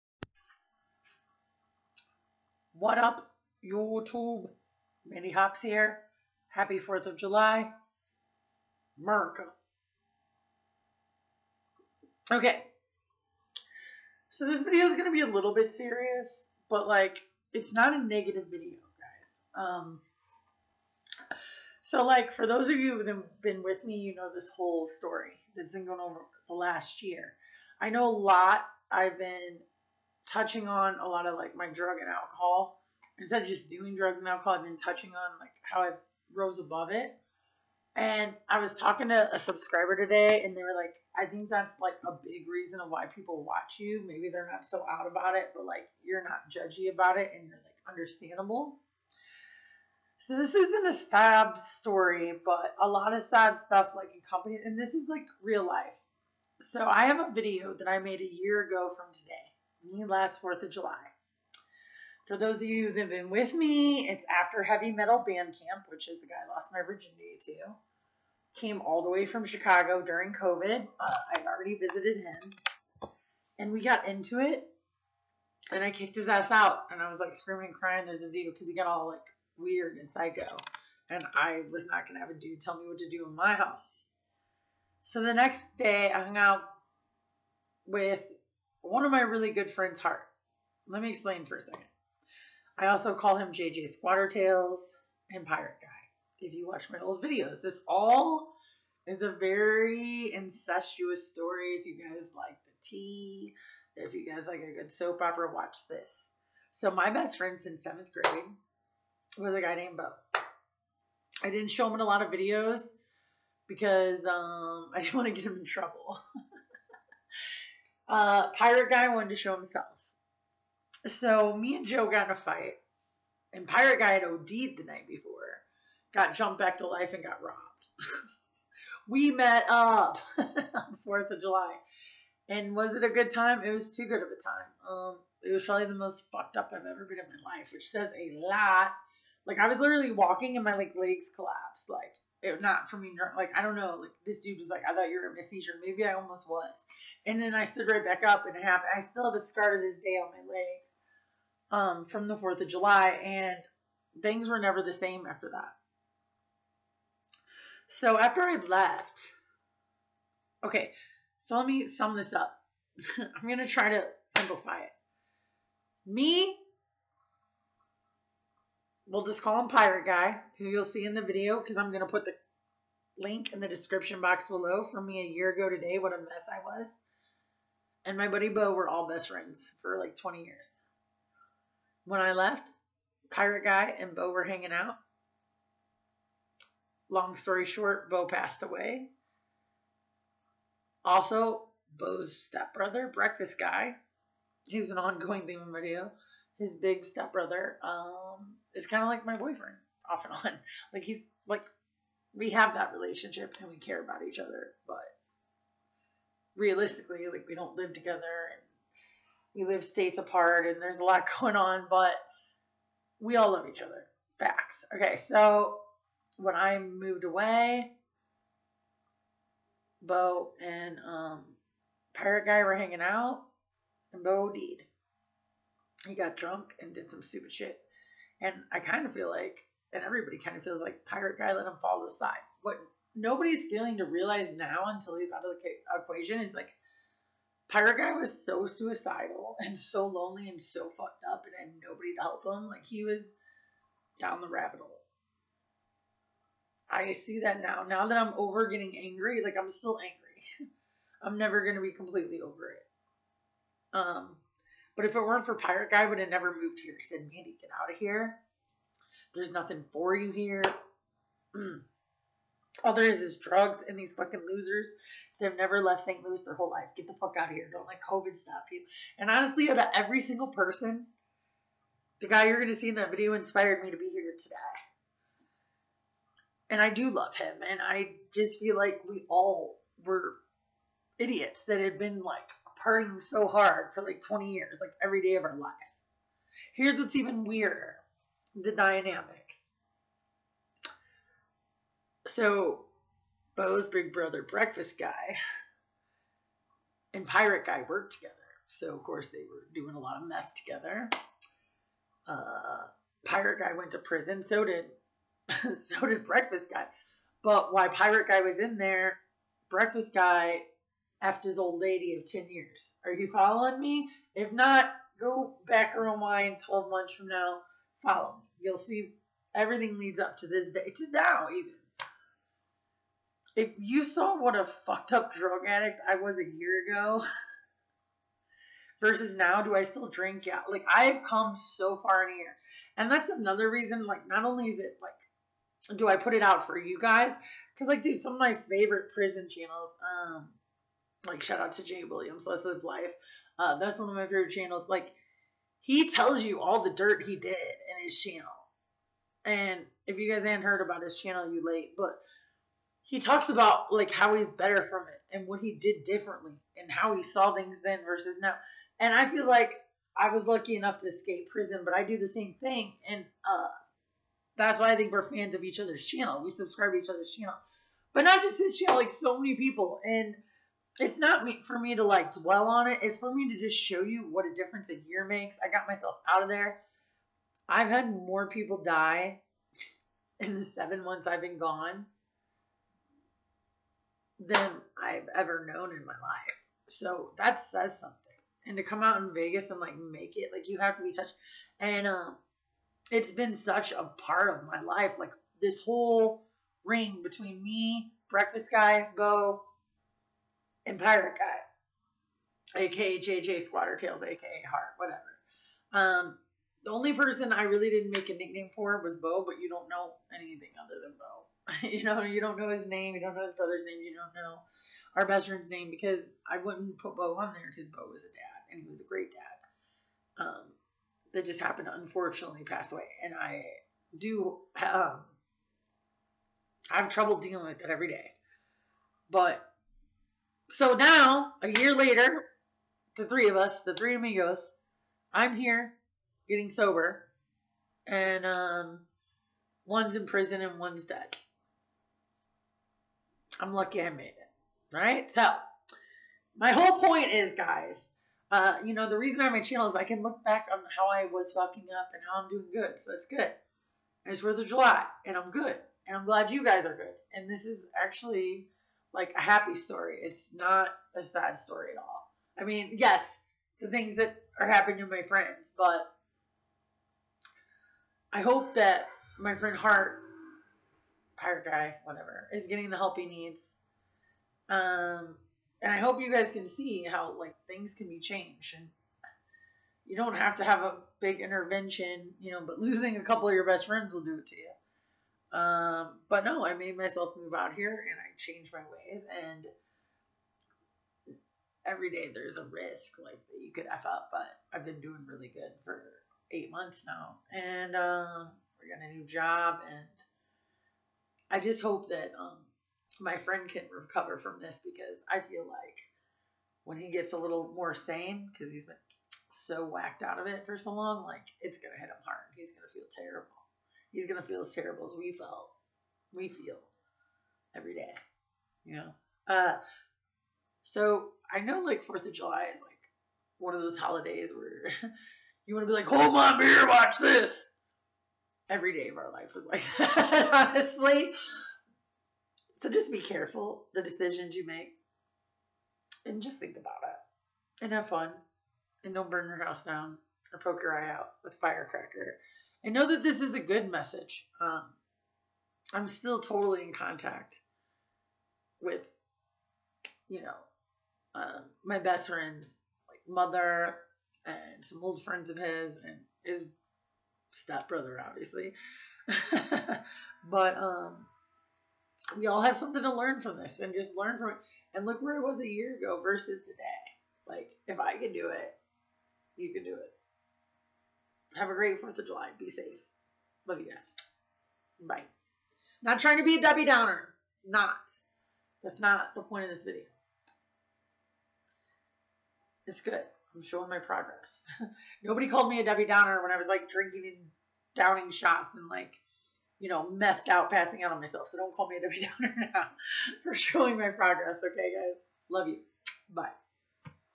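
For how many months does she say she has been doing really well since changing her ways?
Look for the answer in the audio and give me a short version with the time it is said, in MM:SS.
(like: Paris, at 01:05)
8, at 08:16.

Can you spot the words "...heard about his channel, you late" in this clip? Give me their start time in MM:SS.
05:50.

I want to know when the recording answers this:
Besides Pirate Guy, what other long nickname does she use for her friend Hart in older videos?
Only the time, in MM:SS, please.
01:33.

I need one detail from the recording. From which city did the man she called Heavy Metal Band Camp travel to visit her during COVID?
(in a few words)
Chicago.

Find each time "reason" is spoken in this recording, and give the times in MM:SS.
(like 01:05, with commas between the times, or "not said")
00:42, 05:33, 07:29.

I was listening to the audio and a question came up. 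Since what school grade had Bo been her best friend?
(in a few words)
Seventh grade.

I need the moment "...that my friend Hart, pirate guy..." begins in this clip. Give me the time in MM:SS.
07:48.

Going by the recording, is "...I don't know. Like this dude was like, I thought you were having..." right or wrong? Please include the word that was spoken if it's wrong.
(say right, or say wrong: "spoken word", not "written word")
right.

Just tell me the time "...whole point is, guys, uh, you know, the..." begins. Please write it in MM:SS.
07:26.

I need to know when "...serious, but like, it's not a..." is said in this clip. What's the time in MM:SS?
00:15.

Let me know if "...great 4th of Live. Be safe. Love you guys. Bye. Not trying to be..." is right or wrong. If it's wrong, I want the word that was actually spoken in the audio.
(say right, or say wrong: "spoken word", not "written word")
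wrong: "July", not "Live".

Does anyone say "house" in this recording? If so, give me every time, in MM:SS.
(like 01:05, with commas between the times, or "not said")
01:23, 08:59.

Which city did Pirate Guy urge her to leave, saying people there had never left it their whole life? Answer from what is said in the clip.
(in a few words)
St. Louis.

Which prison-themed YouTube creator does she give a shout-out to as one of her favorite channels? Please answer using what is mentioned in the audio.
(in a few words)
Jay Williams.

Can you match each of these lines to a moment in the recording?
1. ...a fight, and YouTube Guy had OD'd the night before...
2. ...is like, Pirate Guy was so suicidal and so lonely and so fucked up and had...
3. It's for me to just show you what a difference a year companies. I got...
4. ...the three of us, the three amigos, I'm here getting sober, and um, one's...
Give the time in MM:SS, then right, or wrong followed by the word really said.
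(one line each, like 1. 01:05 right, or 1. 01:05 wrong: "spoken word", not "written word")
1. 02:02 wrong: "Pirate", not "YouTube"
2. 03:56 right
3. 06:13 wrong: "makes", not "companies"
4. 07:13 right.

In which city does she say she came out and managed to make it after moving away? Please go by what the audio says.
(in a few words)
Vegas.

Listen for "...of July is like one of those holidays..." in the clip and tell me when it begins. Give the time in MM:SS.
08:42.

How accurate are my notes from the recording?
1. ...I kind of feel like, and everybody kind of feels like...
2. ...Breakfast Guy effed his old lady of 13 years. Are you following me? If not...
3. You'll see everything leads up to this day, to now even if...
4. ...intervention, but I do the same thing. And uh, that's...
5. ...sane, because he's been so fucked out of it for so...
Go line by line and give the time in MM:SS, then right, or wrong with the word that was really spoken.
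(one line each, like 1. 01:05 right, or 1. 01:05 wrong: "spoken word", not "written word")
1. 03:48 right
2. 05:09 wrong: "10", not "13"
3. 05:18 right
4. 06:01 wrong: "prison", not "intervention"
5. 08:27 wrong: "whacked", not "fucked".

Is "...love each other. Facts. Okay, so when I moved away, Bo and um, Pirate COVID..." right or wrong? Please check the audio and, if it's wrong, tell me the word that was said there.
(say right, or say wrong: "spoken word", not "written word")
wrong: "Guy", not "COVID".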